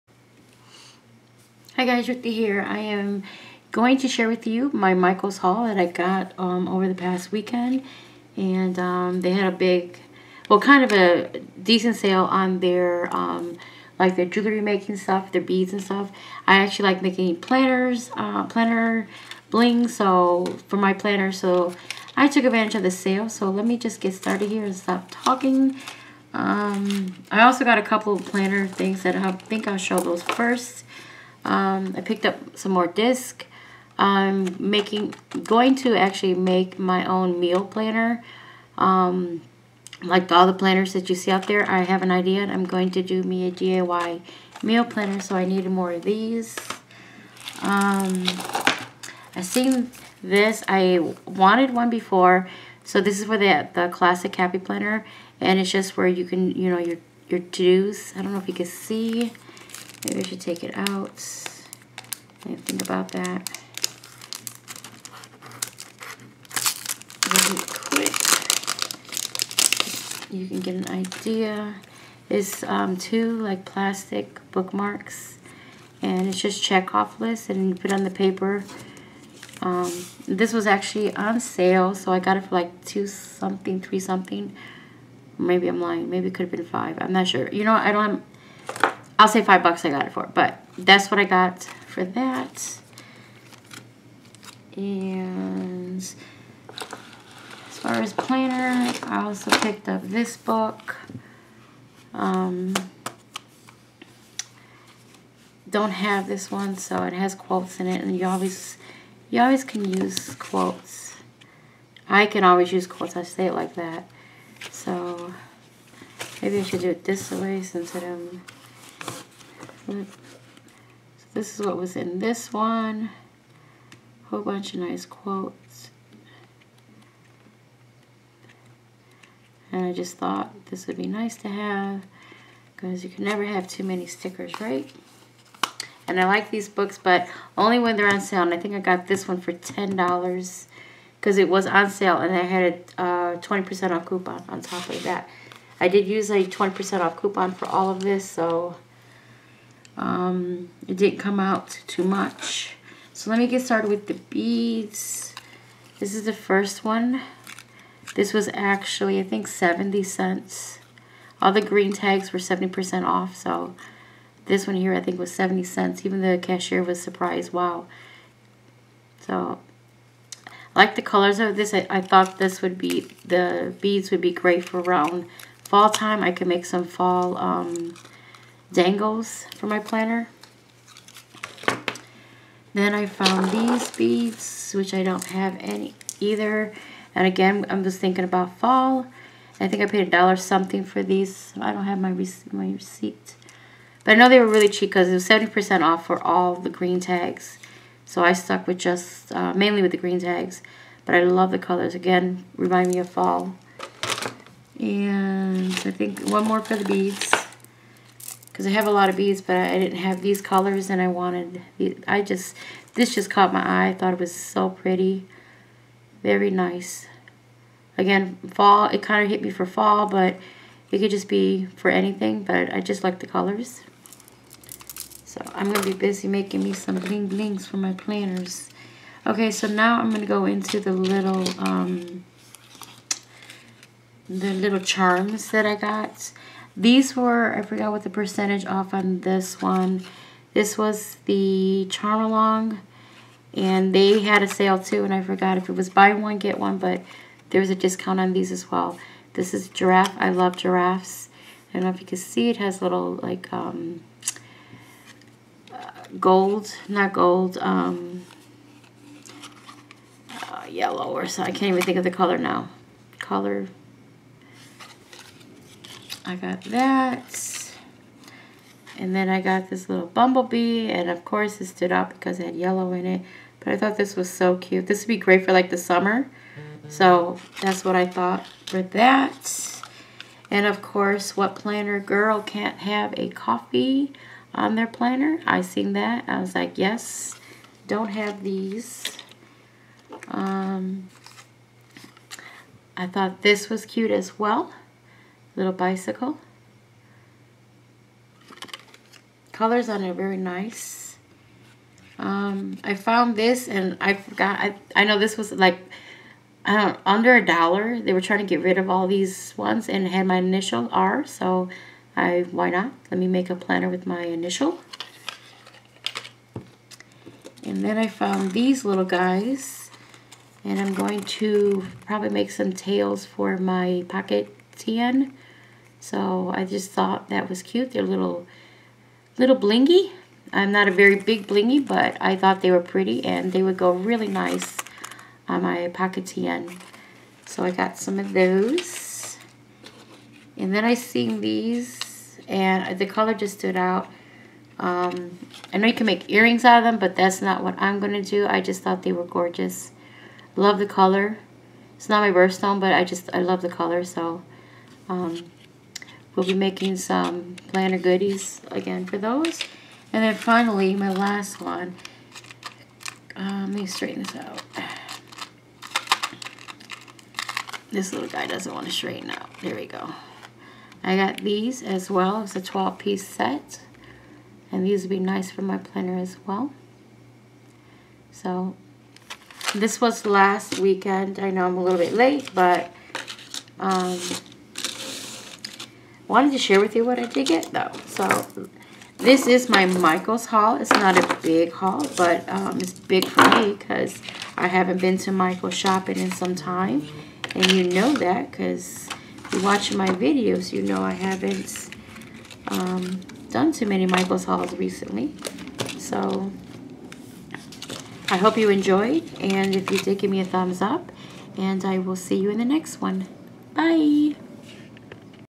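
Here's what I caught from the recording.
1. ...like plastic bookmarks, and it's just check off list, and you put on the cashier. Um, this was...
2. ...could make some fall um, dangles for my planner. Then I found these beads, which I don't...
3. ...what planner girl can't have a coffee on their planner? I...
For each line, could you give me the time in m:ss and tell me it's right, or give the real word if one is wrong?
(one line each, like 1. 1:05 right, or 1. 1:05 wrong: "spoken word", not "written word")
1. 1:13 wrong: "paper", not "cashier"
2. 2:56 right
3. 4:41 right.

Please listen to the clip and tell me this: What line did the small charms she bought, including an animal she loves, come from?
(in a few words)
Charmalong.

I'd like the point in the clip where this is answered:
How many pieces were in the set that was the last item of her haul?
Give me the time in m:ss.
6:12.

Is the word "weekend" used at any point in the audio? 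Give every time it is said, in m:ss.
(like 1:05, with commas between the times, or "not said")
0:07, 6:20.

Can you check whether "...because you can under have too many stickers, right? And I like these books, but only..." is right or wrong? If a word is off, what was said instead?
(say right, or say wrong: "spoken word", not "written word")
wrong: "never", not "under".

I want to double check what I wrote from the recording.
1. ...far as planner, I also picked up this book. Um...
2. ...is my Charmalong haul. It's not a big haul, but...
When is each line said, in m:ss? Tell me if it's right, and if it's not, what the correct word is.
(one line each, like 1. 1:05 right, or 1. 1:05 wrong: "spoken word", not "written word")
1. 1:37 right
2. 6:29 wrong: "Michaels", not "Charmalong".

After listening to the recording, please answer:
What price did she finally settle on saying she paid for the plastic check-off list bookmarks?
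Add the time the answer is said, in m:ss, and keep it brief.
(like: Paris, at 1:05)
$5, at 1:29.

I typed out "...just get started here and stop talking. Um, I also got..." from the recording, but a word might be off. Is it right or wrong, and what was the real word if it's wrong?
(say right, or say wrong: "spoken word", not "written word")
right.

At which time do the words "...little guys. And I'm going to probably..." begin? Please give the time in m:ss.
5:18.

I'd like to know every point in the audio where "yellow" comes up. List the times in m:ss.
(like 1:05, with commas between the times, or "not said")
4:20, 4:32.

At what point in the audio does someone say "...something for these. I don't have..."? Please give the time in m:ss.
3:10.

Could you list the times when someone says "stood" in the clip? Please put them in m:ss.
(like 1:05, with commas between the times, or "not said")
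4:31, 5:43.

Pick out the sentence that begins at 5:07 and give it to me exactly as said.
They were trying to get rid of all these ones and had my initial R.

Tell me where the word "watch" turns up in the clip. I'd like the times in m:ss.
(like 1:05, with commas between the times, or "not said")
6:39.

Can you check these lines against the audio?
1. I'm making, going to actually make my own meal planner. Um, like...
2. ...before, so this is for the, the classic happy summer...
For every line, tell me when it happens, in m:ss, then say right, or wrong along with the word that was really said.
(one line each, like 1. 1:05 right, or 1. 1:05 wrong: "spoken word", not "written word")
1. 0:33 right
2. 0:51 wrong: "planner", not "summer".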